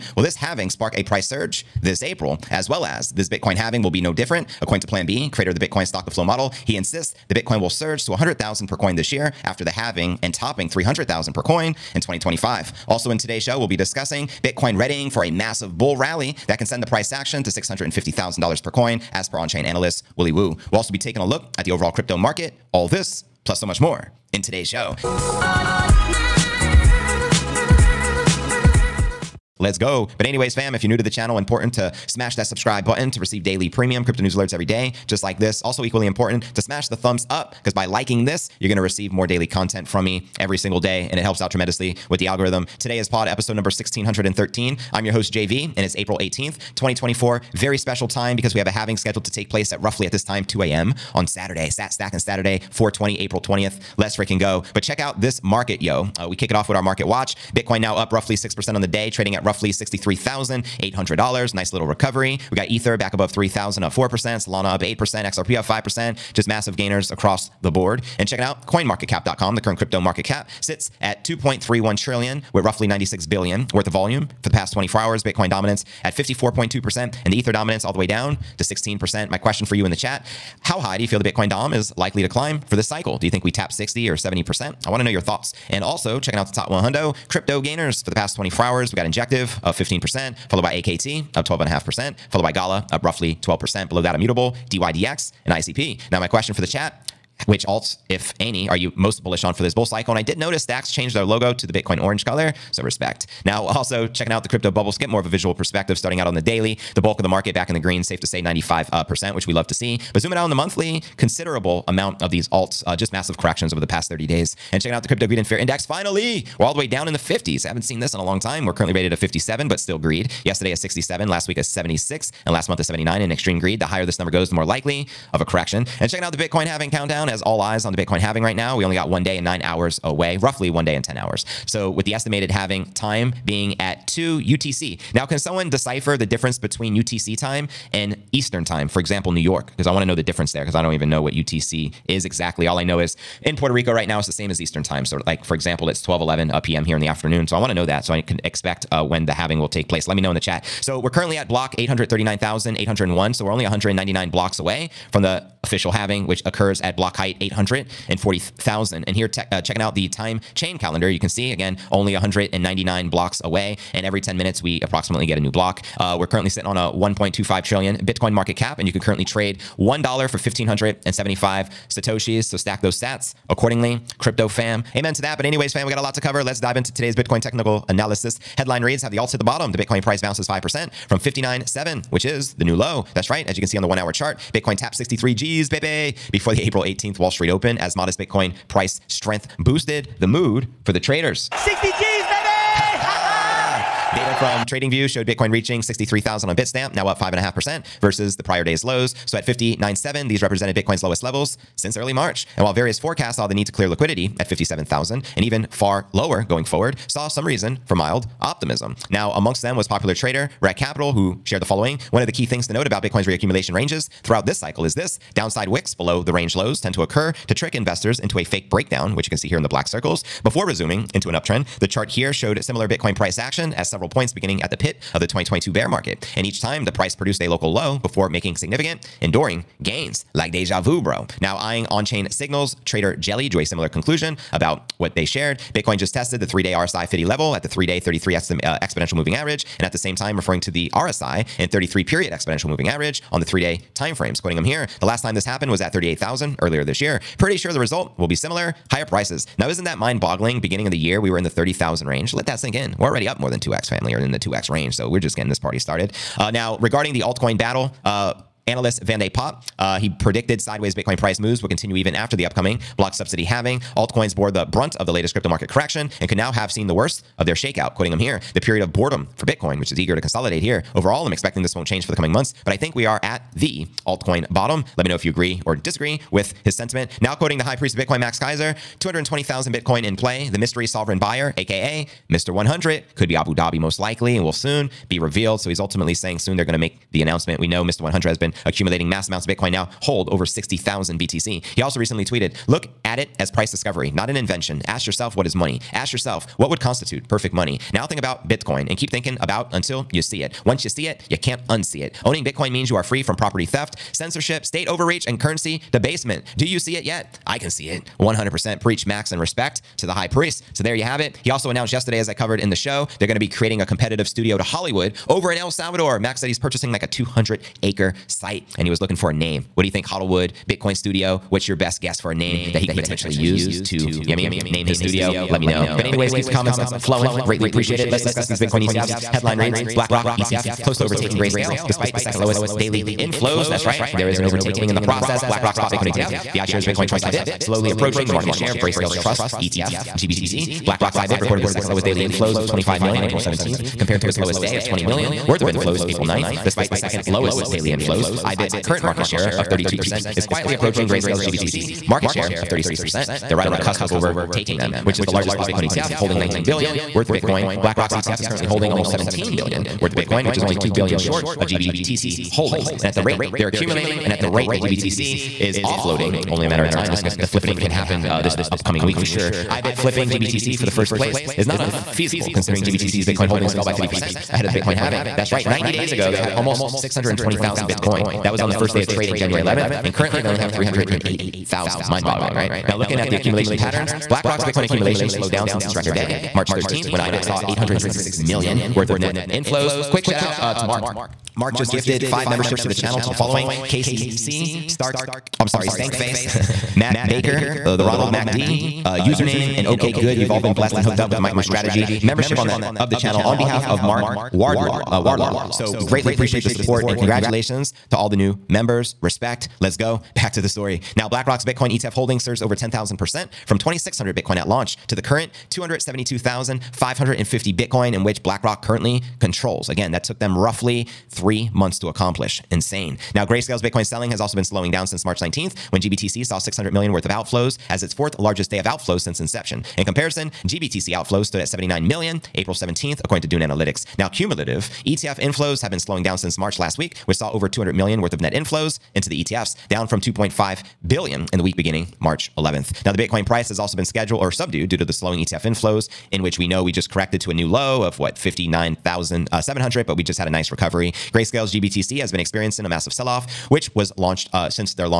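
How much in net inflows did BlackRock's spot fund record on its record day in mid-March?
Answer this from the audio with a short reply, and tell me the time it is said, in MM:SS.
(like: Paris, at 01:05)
$866 million, at 06:27.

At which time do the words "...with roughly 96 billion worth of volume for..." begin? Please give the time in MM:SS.
01:12.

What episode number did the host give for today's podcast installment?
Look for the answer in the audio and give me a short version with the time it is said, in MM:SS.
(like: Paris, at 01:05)
1613, at 00:43.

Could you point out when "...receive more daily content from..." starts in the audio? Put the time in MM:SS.
00:38.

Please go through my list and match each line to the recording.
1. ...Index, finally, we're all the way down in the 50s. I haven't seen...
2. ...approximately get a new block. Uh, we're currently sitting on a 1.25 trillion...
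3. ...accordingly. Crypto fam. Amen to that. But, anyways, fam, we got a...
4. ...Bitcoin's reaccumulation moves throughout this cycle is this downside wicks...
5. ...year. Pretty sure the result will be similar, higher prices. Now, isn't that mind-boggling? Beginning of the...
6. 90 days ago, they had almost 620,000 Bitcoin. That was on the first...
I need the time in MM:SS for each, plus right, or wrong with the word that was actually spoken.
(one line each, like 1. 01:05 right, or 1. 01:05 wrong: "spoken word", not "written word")
1. 01:55 right
2. 02:44 right
3. 02:53 right
4. 03:33 wrong: "ranges", not "moves"
5. 04:06 right
6. 06:15 right.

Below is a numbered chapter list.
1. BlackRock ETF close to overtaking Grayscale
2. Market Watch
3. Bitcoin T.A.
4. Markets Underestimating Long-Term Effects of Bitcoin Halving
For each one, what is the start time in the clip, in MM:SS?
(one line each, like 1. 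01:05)
1. 05:26
2. 00:31
3. 02:54
4. 06:47.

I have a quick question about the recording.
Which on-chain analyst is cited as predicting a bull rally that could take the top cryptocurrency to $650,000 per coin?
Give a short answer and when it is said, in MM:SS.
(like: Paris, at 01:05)
Willy Woo, at 00:20.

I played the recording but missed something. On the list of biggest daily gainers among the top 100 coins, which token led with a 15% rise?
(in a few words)
Injective.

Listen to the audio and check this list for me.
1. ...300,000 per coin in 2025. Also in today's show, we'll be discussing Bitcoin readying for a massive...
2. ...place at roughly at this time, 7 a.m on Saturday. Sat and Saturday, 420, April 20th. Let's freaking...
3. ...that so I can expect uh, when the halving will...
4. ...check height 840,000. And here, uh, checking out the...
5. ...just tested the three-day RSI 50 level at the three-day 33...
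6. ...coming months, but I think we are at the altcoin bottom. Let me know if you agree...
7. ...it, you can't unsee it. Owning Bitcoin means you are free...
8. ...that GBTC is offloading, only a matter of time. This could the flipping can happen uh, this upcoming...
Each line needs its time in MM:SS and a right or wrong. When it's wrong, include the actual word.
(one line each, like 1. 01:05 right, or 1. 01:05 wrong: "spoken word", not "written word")
1. 00:10 right
2. 00:49 wrong: "2", not "7"
3. 02:27 right
4. 02:36 wrong: "block", not "check"
5. 03:55 right
6. 04:32 right
7. 05:01 right
8. 06:04 right.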